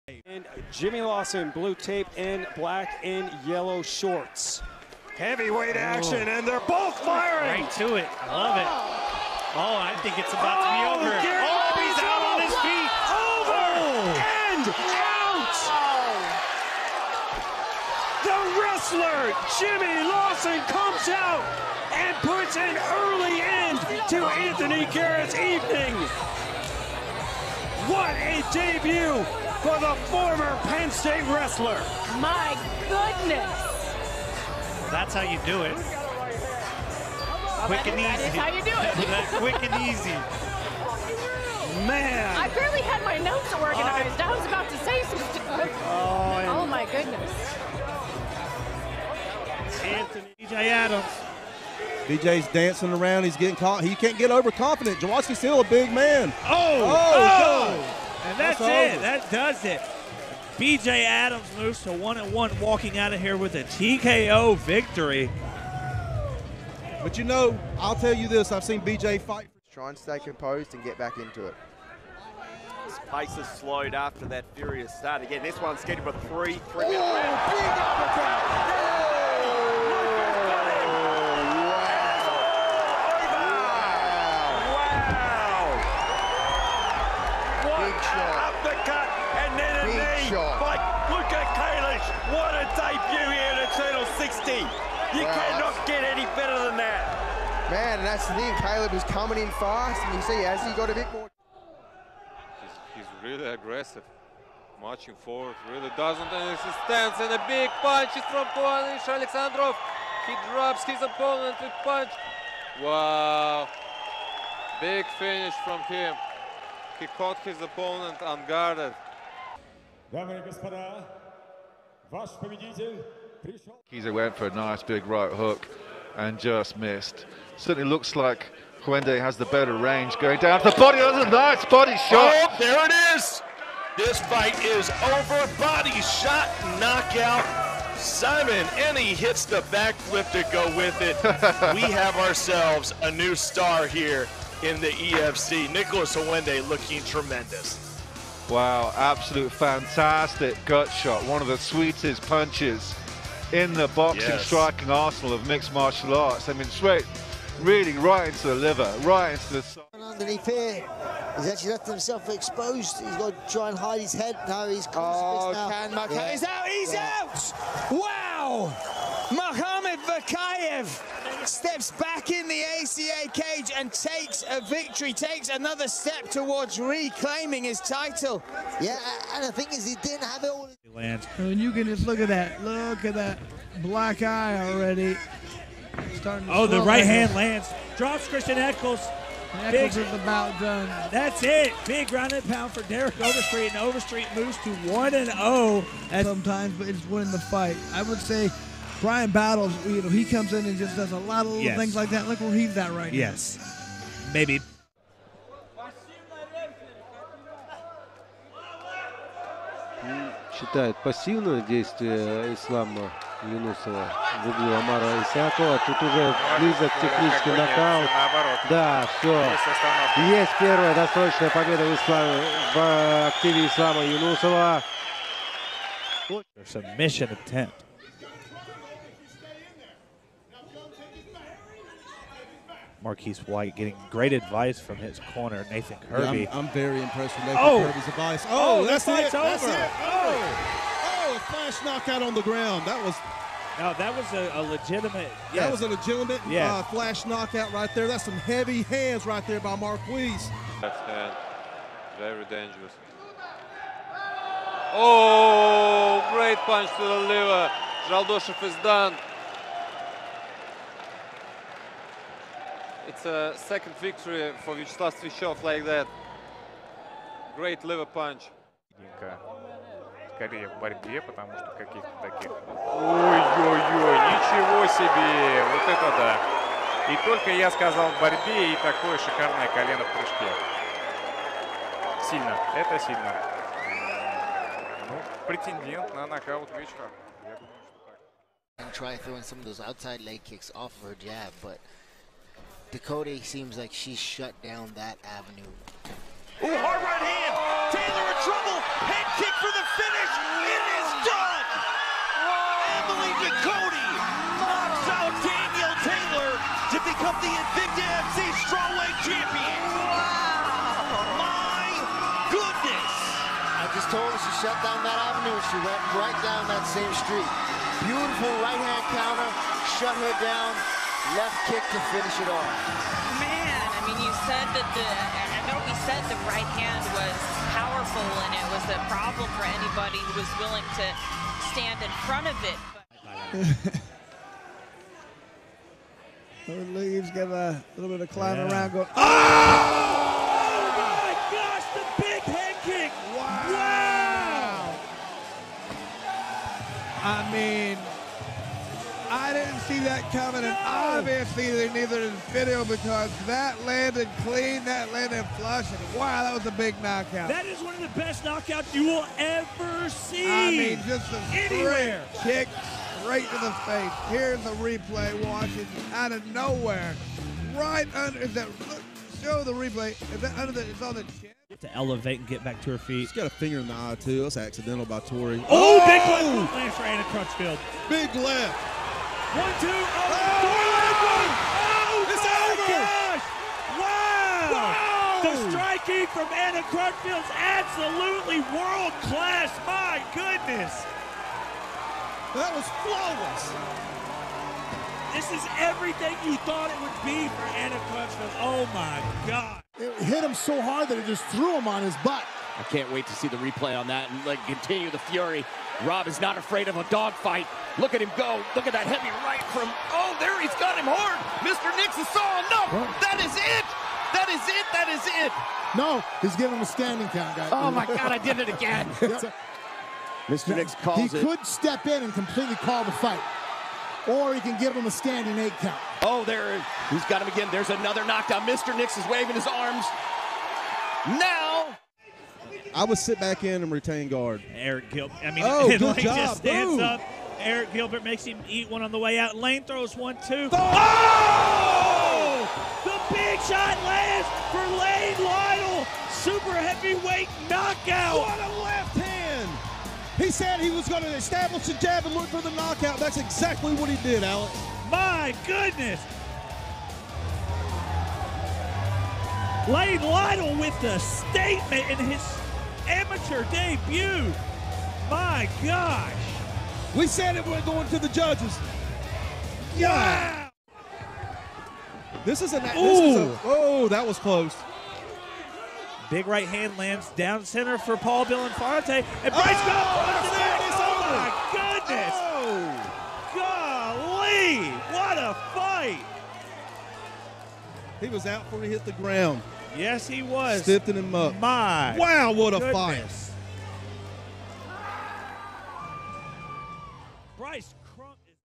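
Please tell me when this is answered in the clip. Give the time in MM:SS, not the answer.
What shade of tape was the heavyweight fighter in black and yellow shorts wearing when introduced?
00:01.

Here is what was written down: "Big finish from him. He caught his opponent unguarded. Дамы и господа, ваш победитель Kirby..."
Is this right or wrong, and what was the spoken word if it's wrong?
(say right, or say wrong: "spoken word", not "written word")
wrong: "Kizer", not "Kirby".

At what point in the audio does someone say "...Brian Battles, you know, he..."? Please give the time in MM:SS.
03:19.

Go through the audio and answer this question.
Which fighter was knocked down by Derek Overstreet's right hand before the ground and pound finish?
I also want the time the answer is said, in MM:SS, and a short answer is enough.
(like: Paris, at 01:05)
Christian Eccles, at 03:08.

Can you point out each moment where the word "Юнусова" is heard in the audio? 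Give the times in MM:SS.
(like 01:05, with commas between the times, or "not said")
03:33, 03:44.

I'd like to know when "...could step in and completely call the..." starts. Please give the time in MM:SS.
07:01.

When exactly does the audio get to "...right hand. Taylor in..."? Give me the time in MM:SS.
04:56.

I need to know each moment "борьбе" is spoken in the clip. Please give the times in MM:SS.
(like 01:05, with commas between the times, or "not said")
04:30, 04:38.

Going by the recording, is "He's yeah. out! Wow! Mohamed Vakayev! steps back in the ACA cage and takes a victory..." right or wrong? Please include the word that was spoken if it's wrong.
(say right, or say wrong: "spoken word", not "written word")
right.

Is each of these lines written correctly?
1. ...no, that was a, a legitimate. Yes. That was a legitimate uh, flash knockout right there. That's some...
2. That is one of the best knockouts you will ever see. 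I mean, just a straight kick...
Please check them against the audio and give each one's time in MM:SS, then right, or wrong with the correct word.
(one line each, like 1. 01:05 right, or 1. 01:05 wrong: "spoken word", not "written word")
1. 04:03 right
2. 05:57 right.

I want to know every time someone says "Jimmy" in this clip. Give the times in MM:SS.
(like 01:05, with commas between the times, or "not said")
00:00, 00:19.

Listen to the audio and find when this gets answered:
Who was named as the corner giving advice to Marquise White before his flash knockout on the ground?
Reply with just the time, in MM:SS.
03:55.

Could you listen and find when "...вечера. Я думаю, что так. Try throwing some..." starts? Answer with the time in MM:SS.
04:46.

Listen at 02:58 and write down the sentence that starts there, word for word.
Yeah, and the thing is, he didn't have it all.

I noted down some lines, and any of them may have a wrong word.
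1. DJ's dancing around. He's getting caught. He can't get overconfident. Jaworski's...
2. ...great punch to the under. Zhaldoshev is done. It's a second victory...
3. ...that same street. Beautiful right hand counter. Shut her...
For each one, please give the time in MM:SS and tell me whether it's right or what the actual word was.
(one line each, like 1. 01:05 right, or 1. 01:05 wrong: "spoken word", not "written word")
1. 00:52 right
2. 04:16 wrong: "liver", not "under"
3. 05:16 right.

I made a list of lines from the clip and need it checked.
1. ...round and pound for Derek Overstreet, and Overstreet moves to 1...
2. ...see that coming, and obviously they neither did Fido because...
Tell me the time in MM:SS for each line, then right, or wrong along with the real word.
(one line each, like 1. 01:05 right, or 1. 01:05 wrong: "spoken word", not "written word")
1. 03:12 right
2. 05:49 right.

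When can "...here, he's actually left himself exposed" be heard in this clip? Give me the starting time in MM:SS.
02:40.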